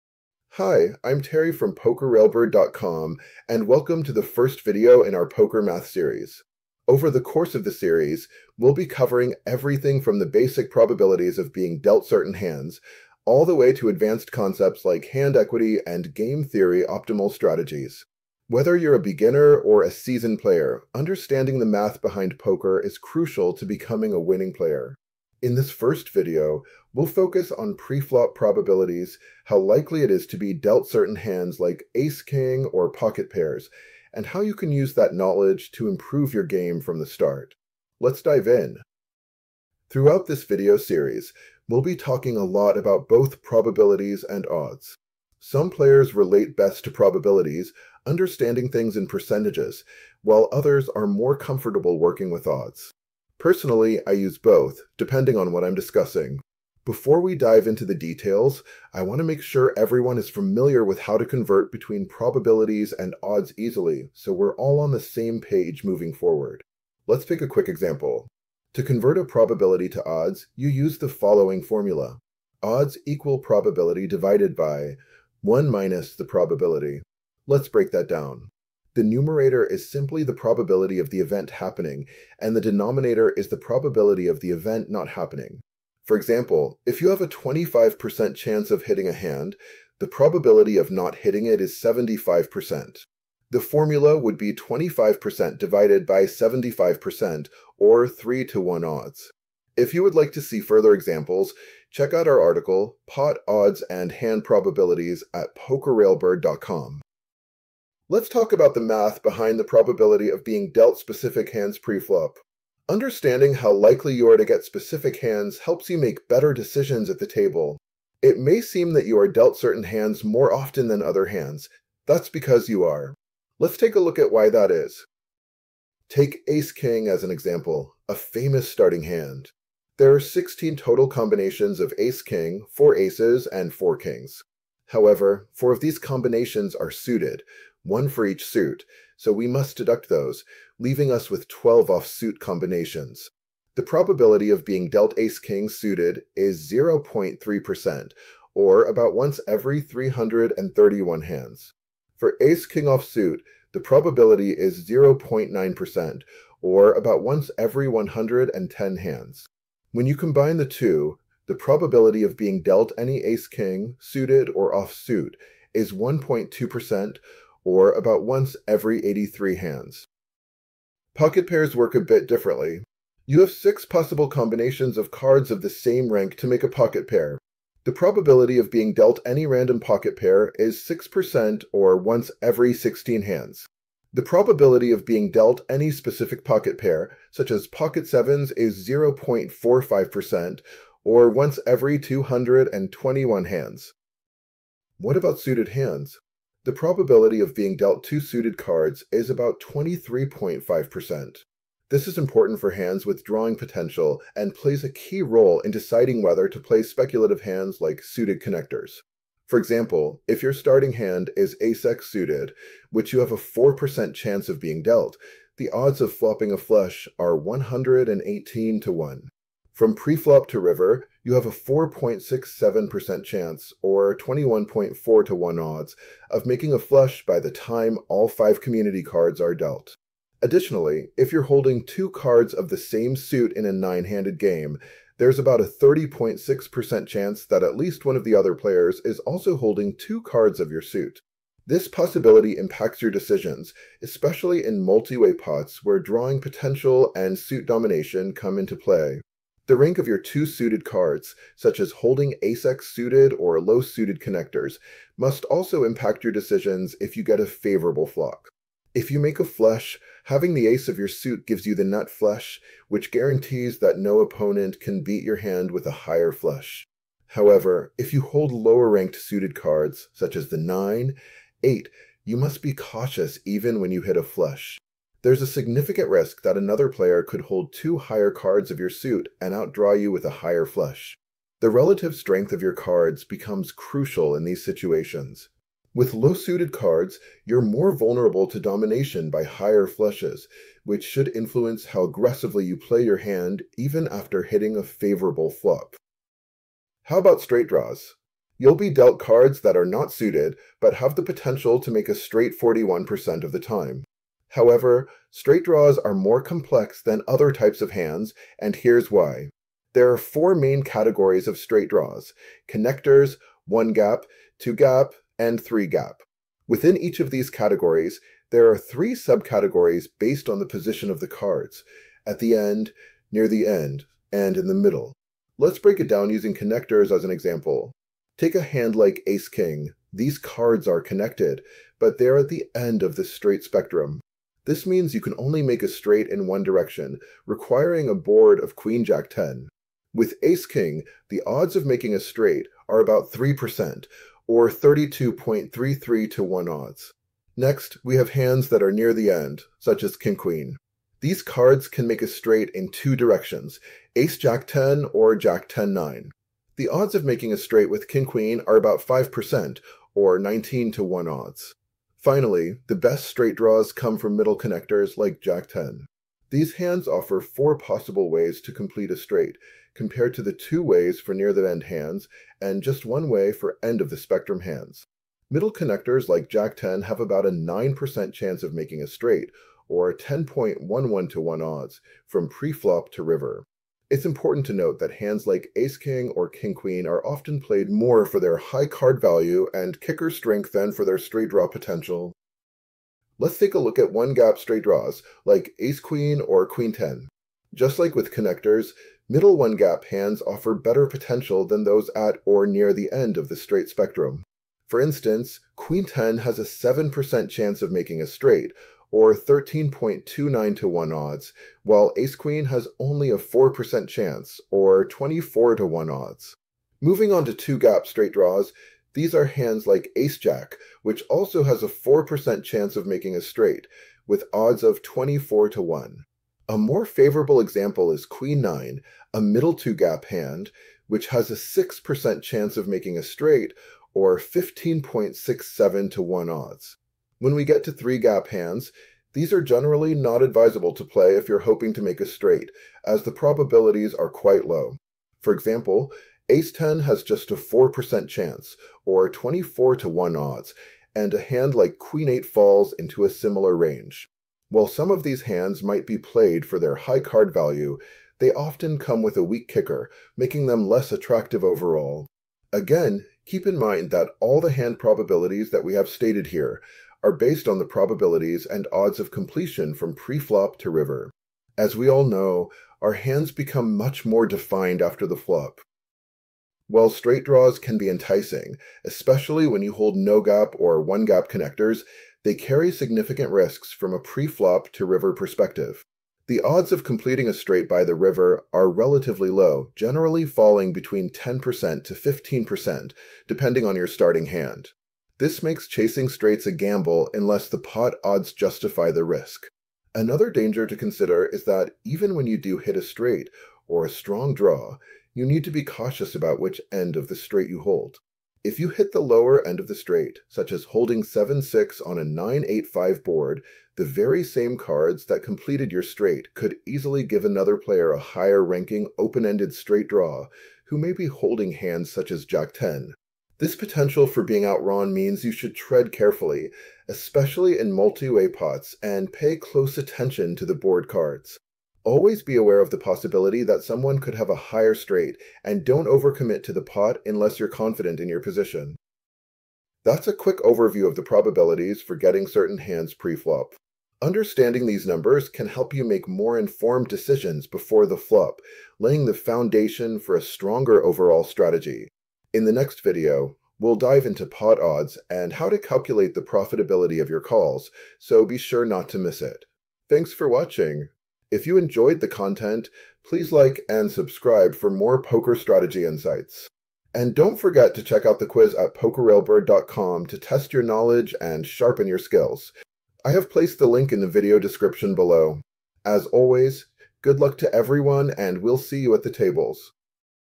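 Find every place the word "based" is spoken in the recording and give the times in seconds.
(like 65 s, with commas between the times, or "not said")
320 s, 467 s.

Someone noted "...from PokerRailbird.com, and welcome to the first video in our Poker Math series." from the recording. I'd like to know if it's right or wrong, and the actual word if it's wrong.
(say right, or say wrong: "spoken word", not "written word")
right.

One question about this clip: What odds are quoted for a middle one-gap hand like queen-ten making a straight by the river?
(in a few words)
13.29 to 1.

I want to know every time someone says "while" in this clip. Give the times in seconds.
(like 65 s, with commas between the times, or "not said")
50 s, 411 s, 454 s, 476 s.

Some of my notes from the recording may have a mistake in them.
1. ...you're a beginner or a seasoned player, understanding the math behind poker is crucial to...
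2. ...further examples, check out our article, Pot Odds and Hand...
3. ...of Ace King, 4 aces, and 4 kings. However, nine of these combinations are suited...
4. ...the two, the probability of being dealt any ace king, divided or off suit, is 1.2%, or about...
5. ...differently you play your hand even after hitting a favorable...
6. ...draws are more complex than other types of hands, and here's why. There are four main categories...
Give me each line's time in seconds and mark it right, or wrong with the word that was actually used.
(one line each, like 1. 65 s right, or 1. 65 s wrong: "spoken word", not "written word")
1. 18 s right
2. 100 s right
3. 131 s wrong: "four", not "nine"
4. 160 s wrong: "suited", not "divided"
5. 292 s wrong: "aggressively", not "differently"
6. 305 s right.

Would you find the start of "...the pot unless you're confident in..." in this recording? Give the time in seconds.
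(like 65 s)
536 s.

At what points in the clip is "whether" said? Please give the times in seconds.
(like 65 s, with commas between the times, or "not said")
18 s, 206 s.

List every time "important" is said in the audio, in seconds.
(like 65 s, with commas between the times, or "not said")
202 s, 384 s.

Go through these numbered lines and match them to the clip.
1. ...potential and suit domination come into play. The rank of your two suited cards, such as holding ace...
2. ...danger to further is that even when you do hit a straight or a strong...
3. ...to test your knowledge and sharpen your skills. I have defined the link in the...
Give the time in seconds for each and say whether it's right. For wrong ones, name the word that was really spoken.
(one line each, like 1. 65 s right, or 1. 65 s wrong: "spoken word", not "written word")
1. 246 s right
2. 500 s wrong: "consider", not "further"
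3. 570 s wrong: "placed", not "defined".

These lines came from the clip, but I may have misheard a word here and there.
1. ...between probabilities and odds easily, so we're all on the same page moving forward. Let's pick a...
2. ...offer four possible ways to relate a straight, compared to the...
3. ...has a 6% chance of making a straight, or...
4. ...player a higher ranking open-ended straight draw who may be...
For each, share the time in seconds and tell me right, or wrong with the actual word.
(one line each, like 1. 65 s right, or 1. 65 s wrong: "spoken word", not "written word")
1. 61 s right
2. 367 s wrong: "complete", not "relate"
3. 431 s right
4. 517 s right.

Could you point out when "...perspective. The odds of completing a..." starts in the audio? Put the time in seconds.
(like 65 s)
485 s.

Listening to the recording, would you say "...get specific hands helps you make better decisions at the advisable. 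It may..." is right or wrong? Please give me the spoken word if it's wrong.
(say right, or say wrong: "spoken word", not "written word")
wrong: "table", not "advisable".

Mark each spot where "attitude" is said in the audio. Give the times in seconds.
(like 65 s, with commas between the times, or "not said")
not said.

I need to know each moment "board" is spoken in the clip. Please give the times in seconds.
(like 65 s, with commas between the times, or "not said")
338 s, 513 s, 530 s.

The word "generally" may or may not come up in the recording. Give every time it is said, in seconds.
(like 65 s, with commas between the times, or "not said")
439 s, 489 s.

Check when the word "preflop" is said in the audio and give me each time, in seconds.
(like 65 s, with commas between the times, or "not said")
27 s, 111 s, 219 s.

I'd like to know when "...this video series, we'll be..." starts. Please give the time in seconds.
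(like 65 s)
40 s.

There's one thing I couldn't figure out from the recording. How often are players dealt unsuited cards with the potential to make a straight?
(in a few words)
41%.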